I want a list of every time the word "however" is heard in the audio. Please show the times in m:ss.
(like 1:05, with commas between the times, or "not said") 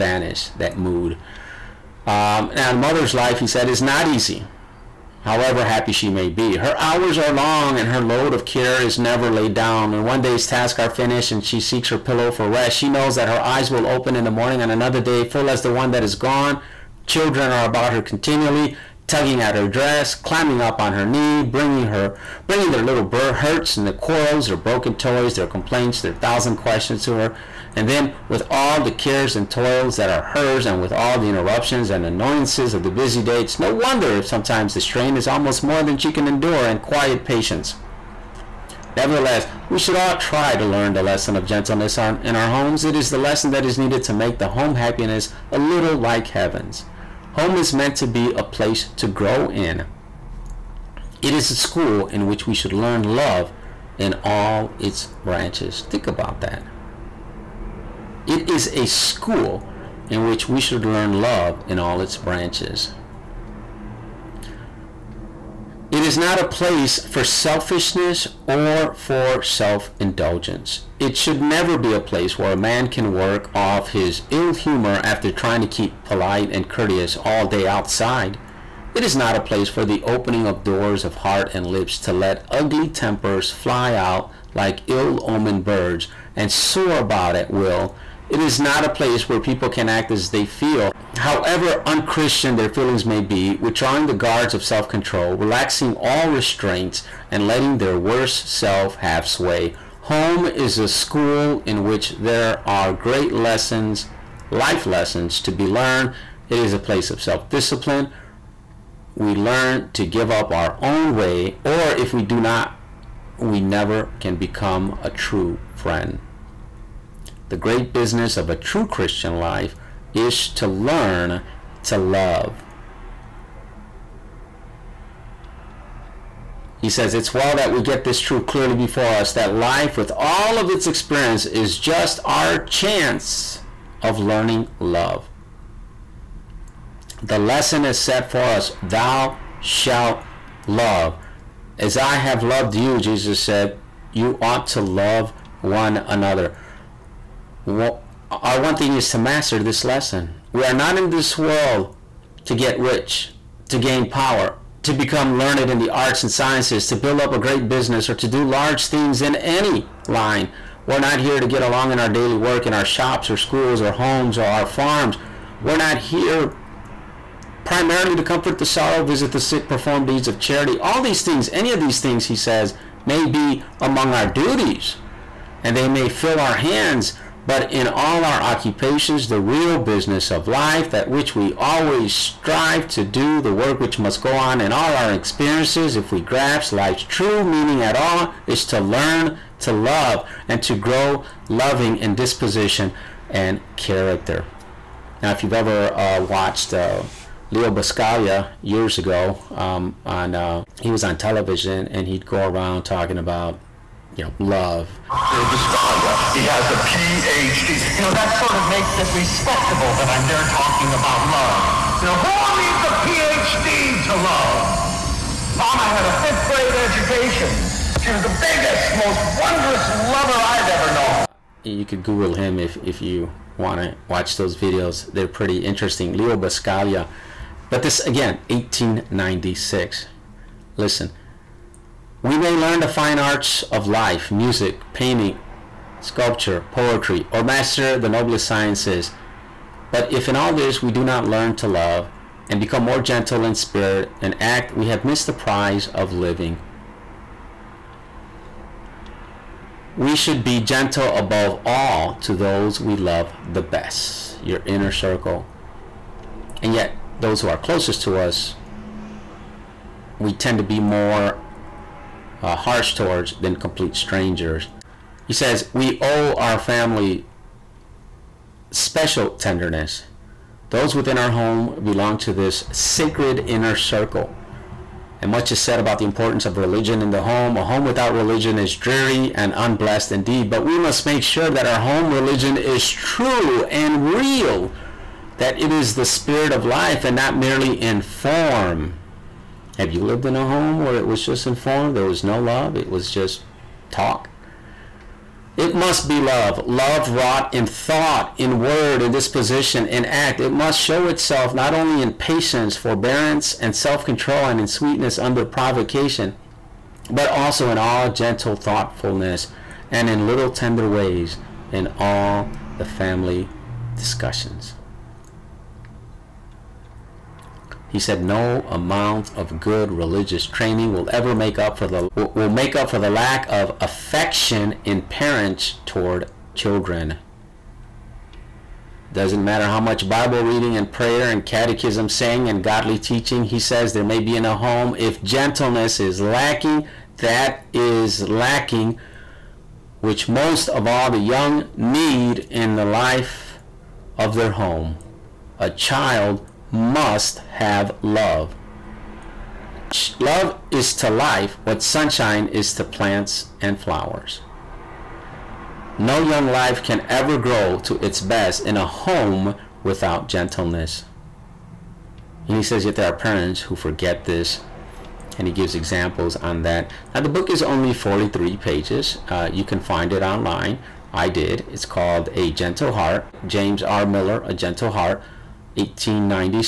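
0:05, 1:31.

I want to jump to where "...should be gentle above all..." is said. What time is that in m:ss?
4:10.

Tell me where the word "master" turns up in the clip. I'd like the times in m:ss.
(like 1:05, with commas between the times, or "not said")
2:29, 3:57.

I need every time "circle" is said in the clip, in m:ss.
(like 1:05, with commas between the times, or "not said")
4:14, 4:33.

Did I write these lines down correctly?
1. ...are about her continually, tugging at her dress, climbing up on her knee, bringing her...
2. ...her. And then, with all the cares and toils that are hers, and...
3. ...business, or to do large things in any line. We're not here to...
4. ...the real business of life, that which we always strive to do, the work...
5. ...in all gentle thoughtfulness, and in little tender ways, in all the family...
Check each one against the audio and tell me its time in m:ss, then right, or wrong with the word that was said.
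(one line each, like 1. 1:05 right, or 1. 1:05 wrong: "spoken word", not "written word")
1. 0:17 right
2. 0:27 right
3. 2:37 right
4. 2:59 right
5. 5:07 right.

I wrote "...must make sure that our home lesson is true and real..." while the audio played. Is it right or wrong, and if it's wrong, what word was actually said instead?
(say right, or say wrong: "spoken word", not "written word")
wrong: "religion", not "lesson".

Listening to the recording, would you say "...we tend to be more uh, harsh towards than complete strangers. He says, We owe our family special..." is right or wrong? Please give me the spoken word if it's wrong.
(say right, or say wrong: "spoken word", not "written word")
right.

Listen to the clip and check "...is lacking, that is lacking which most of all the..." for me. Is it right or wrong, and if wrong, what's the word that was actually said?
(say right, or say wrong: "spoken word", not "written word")
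right.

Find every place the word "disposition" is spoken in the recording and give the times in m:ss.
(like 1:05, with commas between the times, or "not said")
3:12, 4:59.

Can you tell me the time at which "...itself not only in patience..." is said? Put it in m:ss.
5:01.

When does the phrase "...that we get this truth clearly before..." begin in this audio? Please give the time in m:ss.
2:07.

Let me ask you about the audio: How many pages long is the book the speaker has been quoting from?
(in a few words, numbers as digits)
43.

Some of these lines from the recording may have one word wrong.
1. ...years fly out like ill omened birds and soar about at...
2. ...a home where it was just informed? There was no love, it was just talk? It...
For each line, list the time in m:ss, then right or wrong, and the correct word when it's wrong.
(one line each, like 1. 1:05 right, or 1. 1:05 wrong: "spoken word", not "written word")
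1. 1:22 wrong: "tempers", not "years"
2. 4:50 right.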